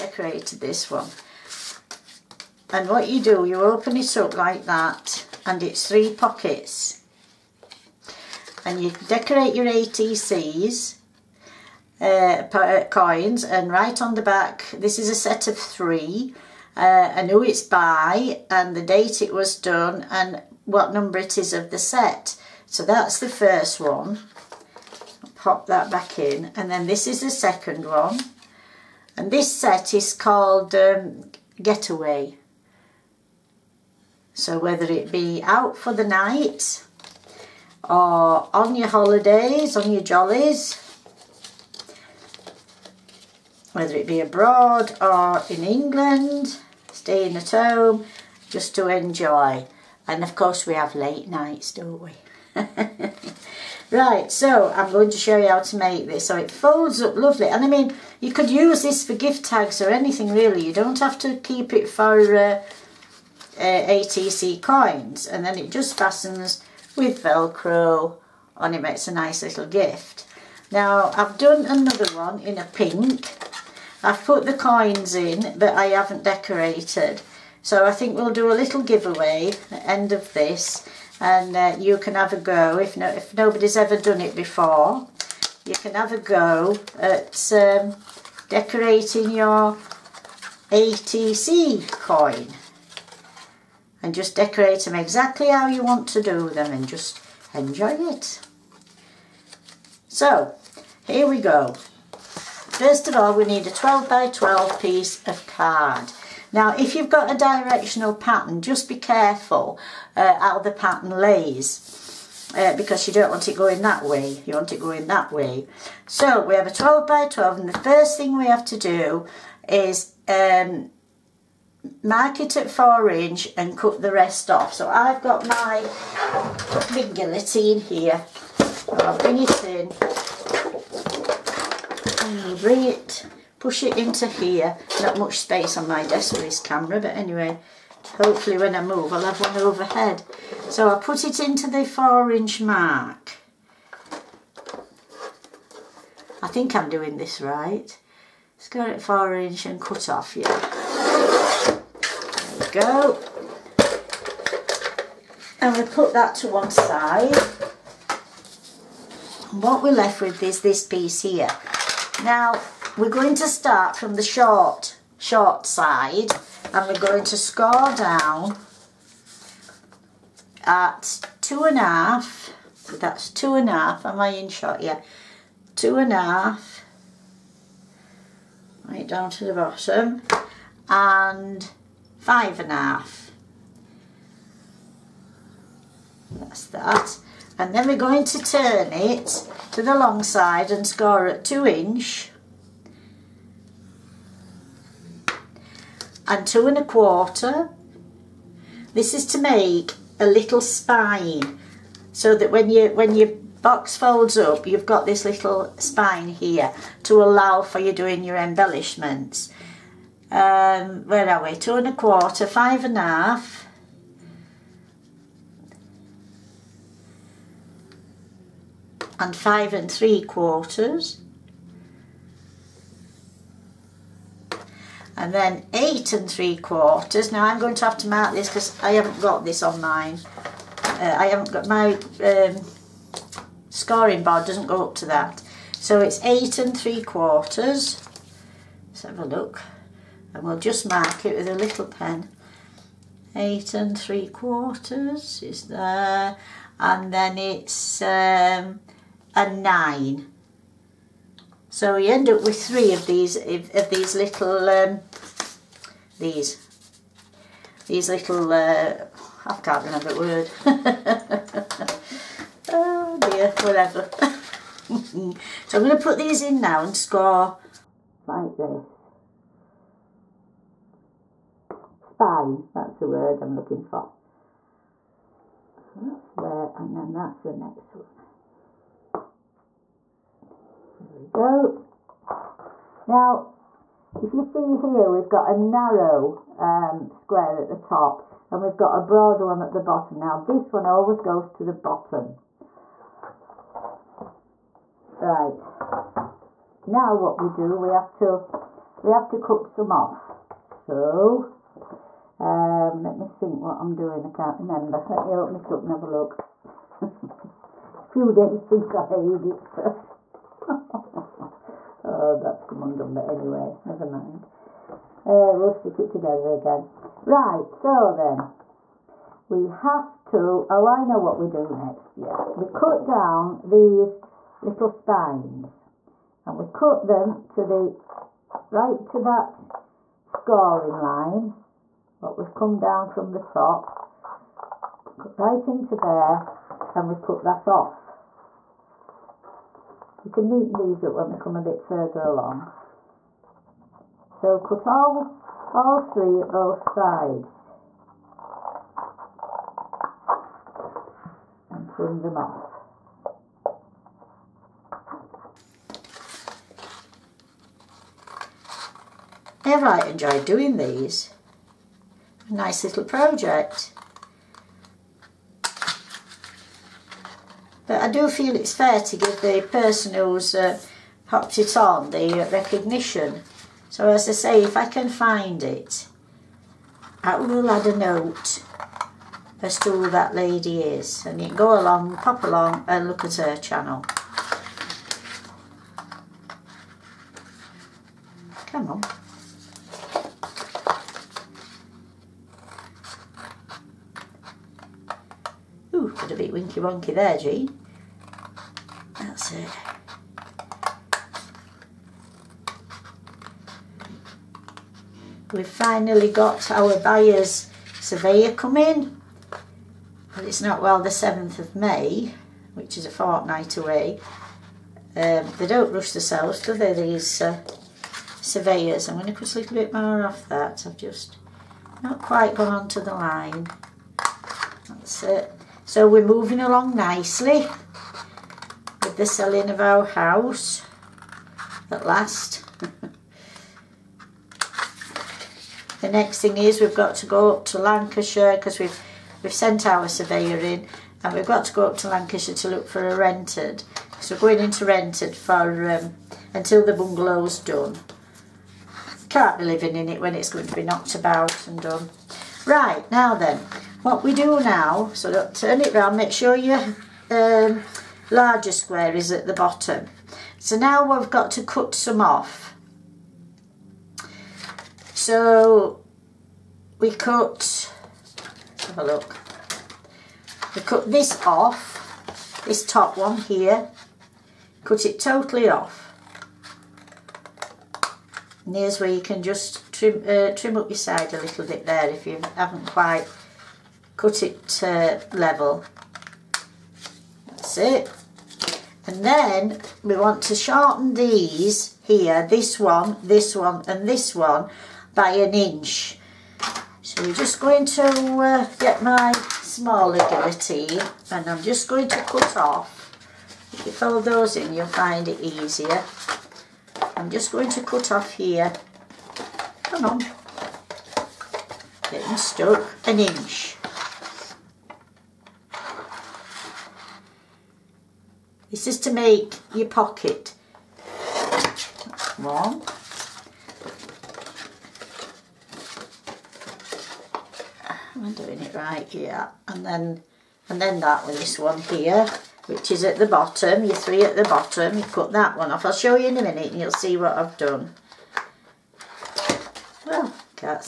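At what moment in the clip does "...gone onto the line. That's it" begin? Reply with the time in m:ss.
7:02.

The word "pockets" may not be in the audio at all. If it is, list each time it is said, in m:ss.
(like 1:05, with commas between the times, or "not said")
0:06, 8:39.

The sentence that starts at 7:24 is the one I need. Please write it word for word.
So we're going into rented for um, until the bungalow's done.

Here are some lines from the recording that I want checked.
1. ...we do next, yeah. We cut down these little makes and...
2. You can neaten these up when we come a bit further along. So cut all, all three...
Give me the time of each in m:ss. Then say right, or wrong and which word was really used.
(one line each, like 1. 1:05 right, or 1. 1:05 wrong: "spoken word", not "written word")
1. 5:21 wrong: "spines", not "makes"
2. 5:40 right.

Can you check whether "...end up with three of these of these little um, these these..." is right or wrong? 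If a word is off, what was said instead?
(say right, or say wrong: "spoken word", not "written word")
right.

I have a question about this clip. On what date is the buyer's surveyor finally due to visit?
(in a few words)
7th of May.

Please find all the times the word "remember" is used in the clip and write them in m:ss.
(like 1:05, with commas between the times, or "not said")
4:19, 5:04.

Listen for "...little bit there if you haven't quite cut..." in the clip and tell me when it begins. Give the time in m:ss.
8:01.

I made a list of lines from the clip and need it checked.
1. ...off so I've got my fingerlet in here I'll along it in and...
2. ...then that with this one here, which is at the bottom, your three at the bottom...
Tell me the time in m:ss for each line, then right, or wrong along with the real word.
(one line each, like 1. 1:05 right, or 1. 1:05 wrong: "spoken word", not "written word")
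1. 2:04 wrong: "bring", not "along"
2. 8:50 right.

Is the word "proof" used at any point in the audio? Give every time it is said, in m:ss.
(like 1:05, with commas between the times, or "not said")
not said.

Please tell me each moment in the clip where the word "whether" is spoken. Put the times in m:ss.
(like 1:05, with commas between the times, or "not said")
0:34, 0:43.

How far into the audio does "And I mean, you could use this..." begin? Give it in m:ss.
0:57.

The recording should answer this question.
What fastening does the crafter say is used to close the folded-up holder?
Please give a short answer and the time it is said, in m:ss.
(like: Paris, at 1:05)
velcro, at 1:07.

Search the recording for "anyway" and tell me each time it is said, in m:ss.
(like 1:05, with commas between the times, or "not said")
2:17, 5:13.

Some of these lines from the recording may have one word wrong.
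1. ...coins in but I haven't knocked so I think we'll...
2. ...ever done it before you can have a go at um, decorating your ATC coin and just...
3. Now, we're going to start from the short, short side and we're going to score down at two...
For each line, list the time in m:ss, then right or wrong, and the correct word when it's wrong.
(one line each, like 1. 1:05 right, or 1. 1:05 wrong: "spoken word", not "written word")
1. 1:14 wrong: "decorated", not "knocked"
2. 1:23 right
3. 2:42 right.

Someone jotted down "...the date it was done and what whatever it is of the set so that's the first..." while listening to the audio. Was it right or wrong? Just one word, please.
wrong.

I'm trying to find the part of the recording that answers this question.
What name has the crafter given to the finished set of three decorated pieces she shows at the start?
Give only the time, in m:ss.
0:31.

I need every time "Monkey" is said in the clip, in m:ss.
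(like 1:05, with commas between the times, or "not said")
6:36.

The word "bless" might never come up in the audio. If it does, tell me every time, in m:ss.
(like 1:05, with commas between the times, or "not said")
not said.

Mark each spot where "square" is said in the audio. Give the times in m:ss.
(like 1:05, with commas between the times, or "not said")
4:47, 7:38.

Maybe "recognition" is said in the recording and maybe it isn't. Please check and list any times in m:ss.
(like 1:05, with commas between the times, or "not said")
6:12.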